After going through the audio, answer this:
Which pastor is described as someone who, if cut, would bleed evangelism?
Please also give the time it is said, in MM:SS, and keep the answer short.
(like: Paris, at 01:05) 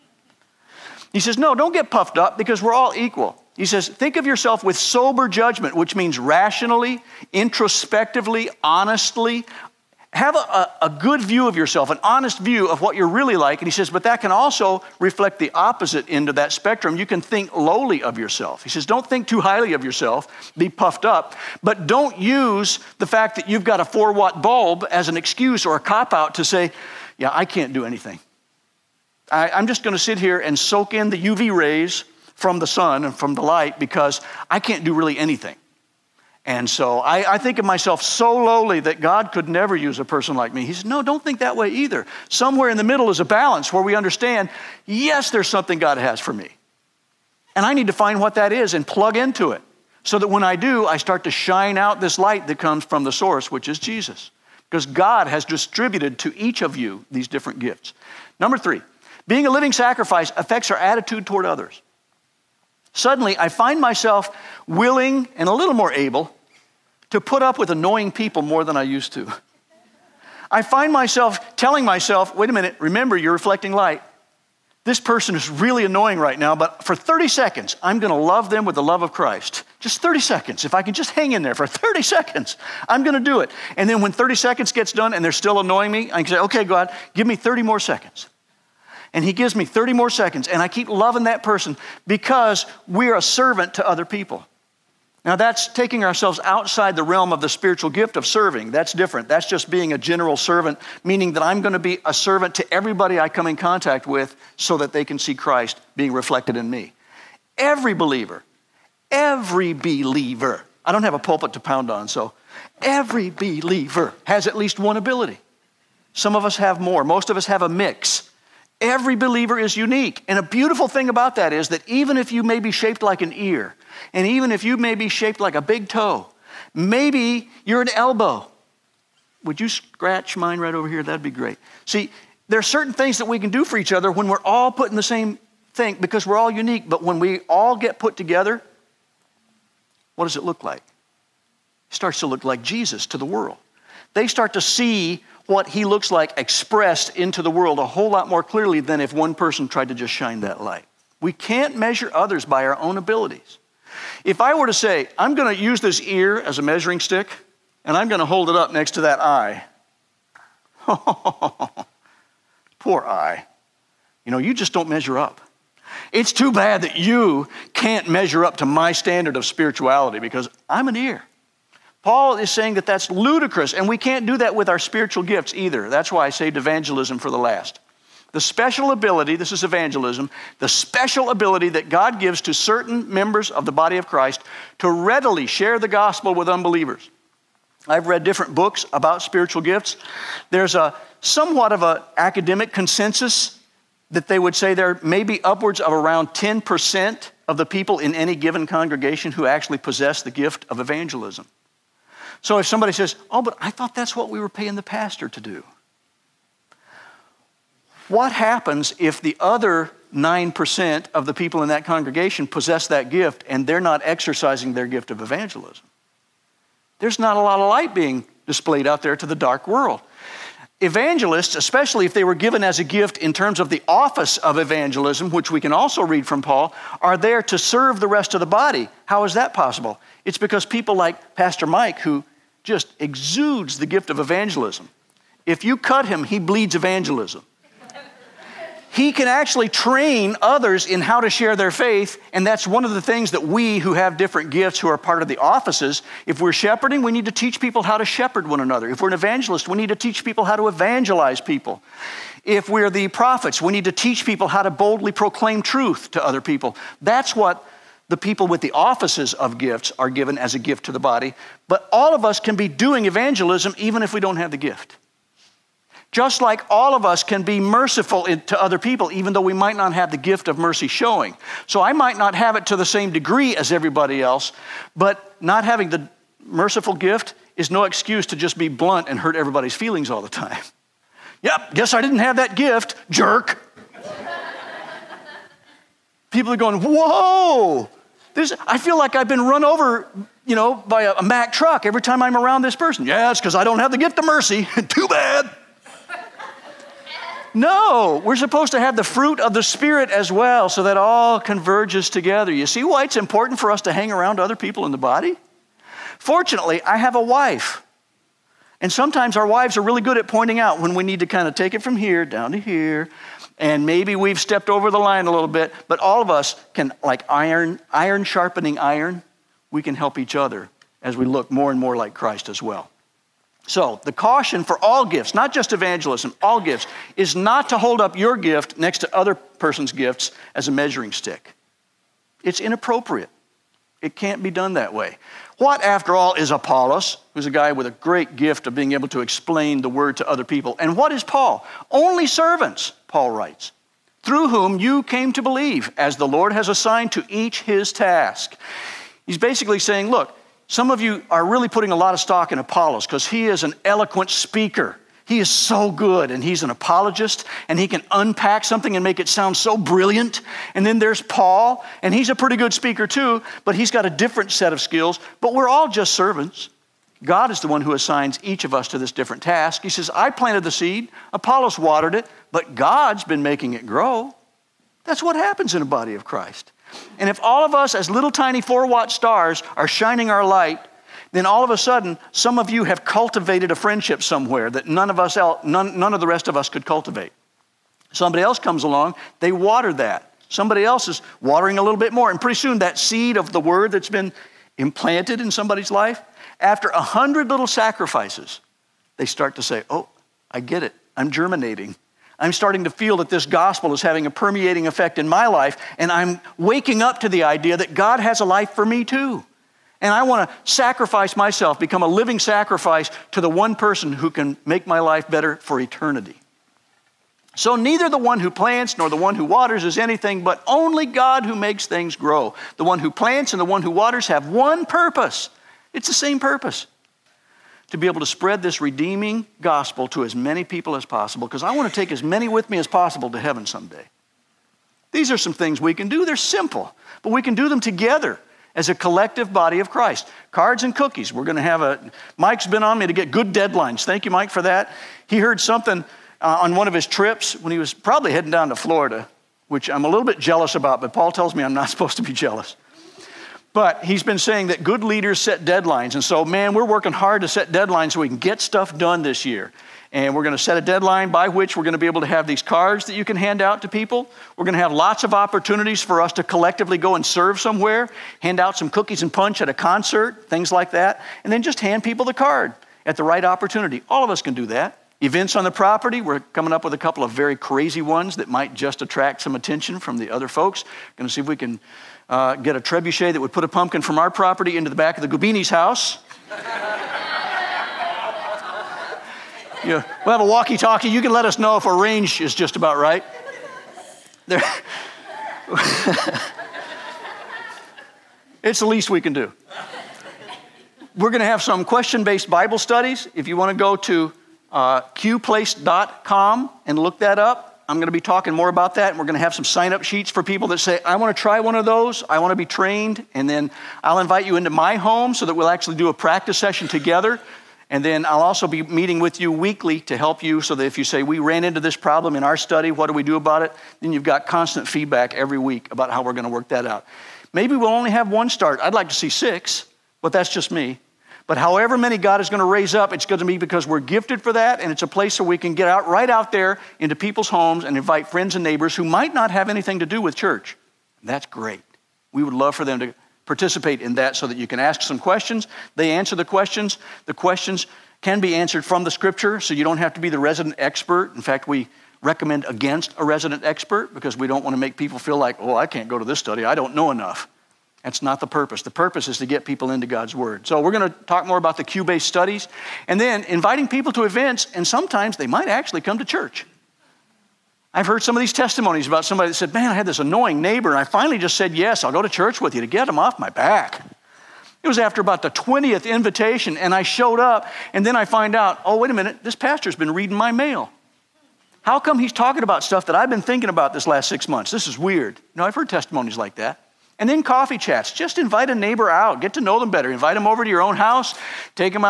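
Pastor Mike, at 03:51.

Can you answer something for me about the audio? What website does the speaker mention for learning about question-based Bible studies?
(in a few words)
qplace.com.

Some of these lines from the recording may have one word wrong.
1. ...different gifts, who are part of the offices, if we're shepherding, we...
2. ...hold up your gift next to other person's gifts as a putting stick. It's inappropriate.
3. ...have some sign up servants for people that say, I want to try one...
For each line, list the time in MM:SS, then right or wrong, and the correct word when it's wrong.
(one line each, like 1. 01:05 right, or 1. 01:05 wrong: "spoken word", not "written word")
1. 04:04 right
2. 05:27 wrong: "measuring", not "putting"
3. 08:29 wrong: "sheets", not "servants".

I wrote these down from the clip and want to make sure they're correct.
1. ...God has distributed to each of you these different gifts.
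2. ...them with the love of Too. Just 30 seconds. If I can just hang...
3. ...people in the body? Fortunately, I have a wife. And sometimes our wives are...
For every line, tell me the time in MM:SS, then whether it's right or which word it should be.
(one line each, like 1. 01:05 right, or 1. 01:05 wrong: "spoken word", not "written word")
1. 00:54 right
2. 01:18 wrong: "Christ", not "Too"
3. 05:04 right.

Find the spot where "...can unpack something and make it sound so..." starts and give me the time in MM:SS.
05:57.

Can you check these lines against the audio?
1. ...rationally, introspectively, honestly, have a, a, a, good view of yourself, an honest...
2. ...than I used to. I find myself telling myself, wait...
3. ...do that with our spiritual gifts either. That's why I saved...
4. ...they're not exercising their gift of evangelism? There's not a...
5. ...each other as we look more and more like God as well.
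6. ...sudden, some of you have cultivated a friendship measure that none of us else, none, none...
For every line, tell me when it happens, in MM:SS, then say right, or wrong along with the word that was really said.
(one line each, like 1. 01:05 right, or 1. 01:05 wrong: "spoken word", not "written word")
1. 00:06 right
2. 01:08 right
3. 02:54 right
4. 03:33 right
5. 05:20 wrong: "Christ", not "God"
6. 06:21 wrong: "somewhere", not "measure".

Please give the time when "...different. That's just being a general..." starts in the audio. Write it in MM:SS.
01:38.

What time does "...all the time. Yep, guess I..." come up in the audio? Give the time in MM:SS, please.
04:40.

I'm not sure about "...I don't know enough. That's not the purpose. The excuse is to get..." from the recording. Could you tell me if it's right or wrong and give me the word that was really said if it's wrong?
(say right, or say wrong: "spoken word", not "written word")
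wrong: "purpose", not "excuse".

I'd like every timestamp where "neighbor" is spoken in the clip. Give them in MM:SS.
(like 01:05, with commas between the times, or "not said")
08:58, 09:30, 09:48.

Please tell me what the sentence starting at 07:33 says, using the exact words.
But he's been saying that good leaders set deadlines.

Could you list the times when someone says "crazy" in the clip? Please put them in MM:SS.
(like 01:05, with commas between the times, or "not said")
07:57.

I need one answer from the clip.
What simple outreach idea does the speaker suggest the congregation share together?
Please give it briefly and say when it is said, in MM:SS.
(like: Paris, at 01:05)
Cards and cookies, at 07:20.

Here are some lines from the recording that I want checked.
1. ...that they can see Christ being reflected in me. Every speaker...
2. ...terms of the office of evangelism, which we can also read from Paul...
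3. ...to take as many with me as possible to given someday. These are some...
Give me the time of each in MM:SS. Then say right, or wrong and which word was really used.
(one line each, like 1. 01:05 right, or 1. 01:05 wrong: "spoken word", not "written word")
1. 01:44 wrong: "believer", not "speaker"
2. 03:43 right
3. 07:11 wrong: "heaven", not "given".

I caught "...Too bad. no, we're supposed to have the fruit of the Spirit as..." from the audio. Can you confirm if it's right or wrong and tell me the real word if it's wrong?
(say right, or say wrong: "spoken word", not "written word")
right.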